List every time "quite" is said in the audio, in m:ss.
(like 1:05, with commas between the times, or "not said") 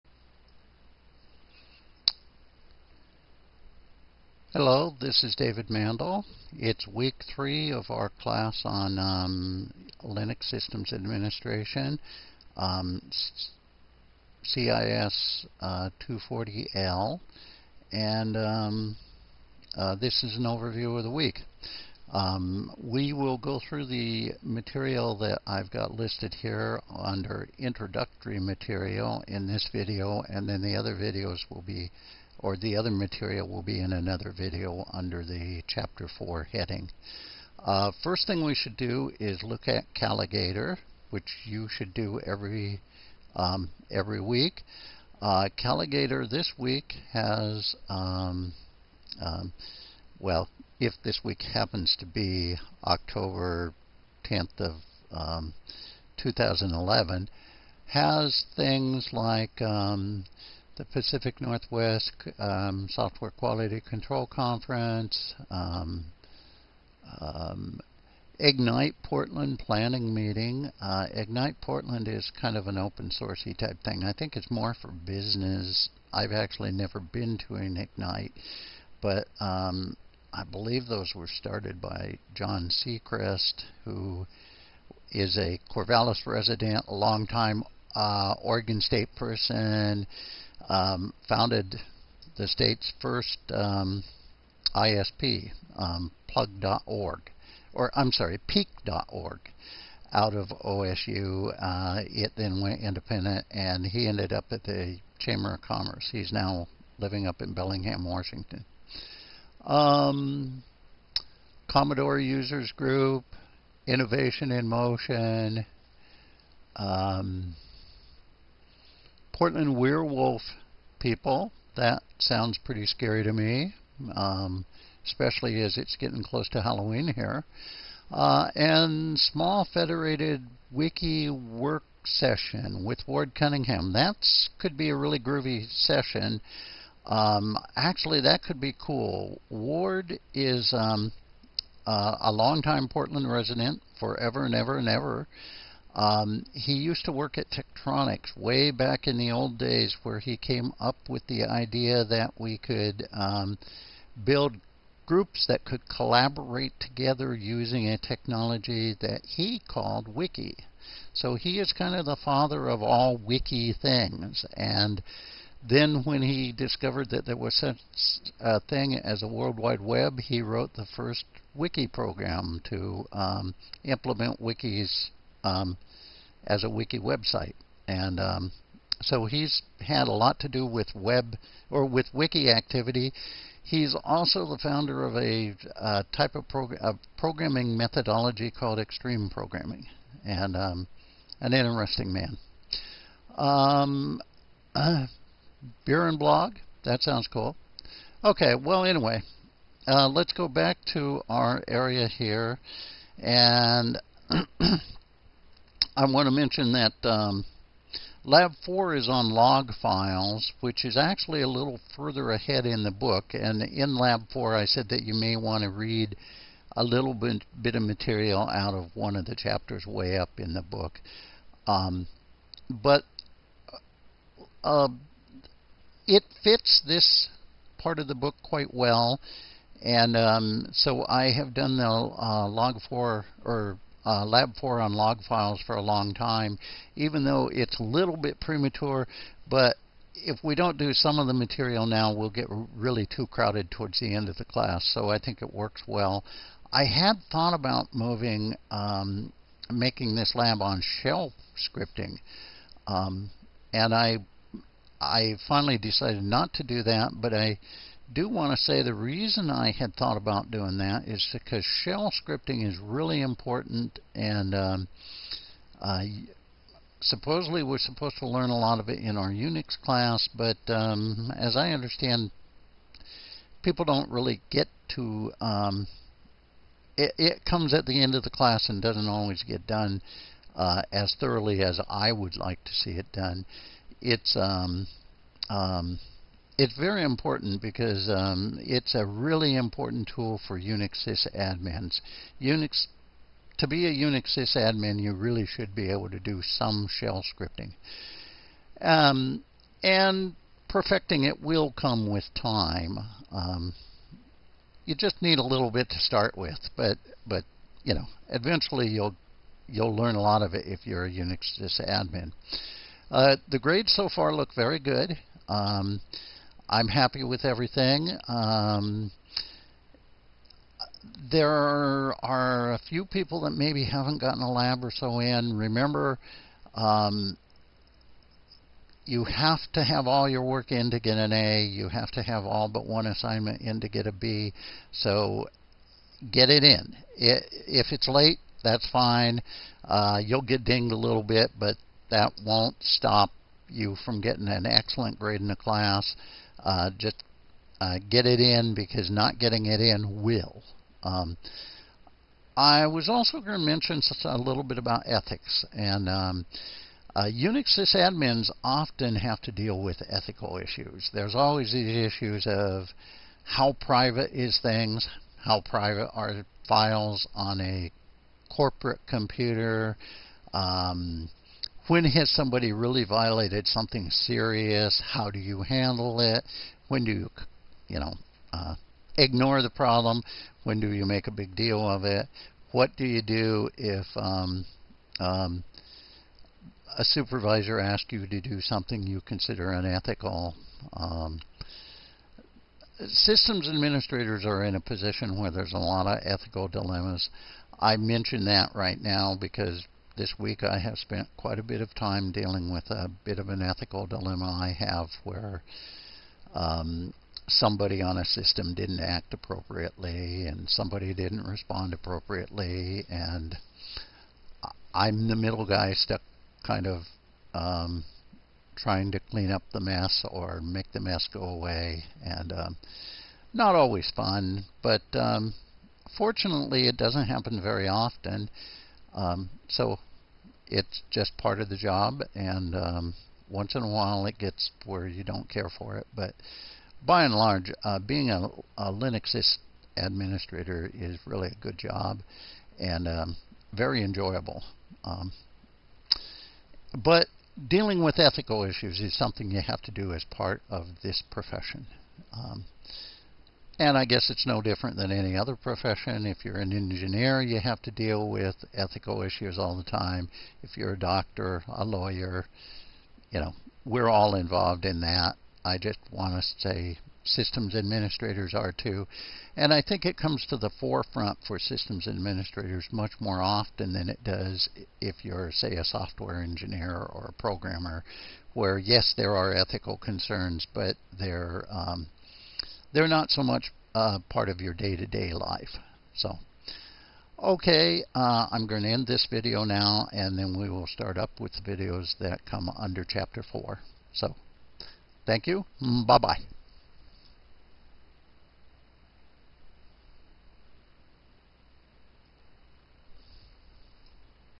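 3:48, 6:41.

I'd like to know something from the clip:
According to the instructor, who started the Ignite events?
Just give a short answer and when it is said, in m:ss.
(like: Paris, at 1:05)
John Seacrest, at 1:22.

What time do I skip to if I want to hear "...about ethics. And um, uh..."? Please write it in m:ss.
5:54.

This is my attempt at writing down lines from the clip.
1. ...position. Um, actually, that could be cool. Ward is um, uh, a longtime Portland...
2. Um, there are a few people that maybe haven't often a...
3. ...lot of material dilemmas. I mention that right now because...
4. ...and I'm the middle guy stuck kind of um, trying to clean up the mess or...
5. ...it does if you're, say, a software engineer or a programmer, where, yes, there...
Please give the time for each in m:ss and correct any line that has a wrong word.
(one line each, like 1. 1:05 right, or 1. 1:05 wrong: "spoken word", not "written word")
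1. 2:15 wrong: "session", not "position"
2. 5:18 wrong: "gotten", not "often"
3. 6:35 wrong: "ethical", not "material"
4. 6:53 right
5. 7:54 right.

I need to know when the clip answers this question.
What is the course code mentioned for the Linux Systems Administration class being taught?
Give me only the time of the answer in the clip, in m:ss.
0:14.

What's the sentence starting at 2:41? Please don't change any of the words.
So he is kind of the father of all Wiki things.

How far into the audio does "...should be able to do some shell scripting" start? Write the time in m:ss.
4:55.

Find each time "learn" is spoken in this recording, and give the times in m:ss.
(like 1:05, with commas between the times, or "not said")
4:28, 5:09.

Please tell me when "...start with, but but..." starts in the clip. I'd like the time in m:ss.
5:05.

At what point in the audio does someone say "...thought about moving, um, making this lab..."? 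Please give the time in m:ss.
4:07.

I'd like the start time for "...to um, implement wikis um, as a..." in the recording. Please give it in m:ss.
2:52.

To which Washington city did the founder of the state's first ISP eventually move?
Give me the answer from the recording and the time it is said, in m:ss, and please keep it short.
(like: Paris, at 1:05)
Bellingham, at 1:47.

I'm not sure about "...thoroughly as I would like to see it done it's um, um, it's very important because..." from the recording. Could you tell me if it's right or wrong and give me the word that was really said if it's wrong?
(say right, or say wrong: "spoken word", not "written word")
right.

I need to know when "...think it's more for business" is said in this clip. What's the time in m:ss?
1:14.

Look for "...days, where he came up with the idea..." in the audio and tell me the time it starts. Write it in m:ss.
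2:29.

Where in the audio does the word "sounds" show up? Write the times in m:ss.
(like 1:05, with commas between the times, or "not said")
2:02, 3:17.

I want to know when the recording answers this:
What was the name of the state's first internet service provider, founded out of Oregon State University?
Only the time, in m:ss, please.
1:38.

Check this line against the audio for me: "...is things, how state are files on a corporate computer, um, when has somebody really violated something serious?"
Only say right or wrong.
wrong.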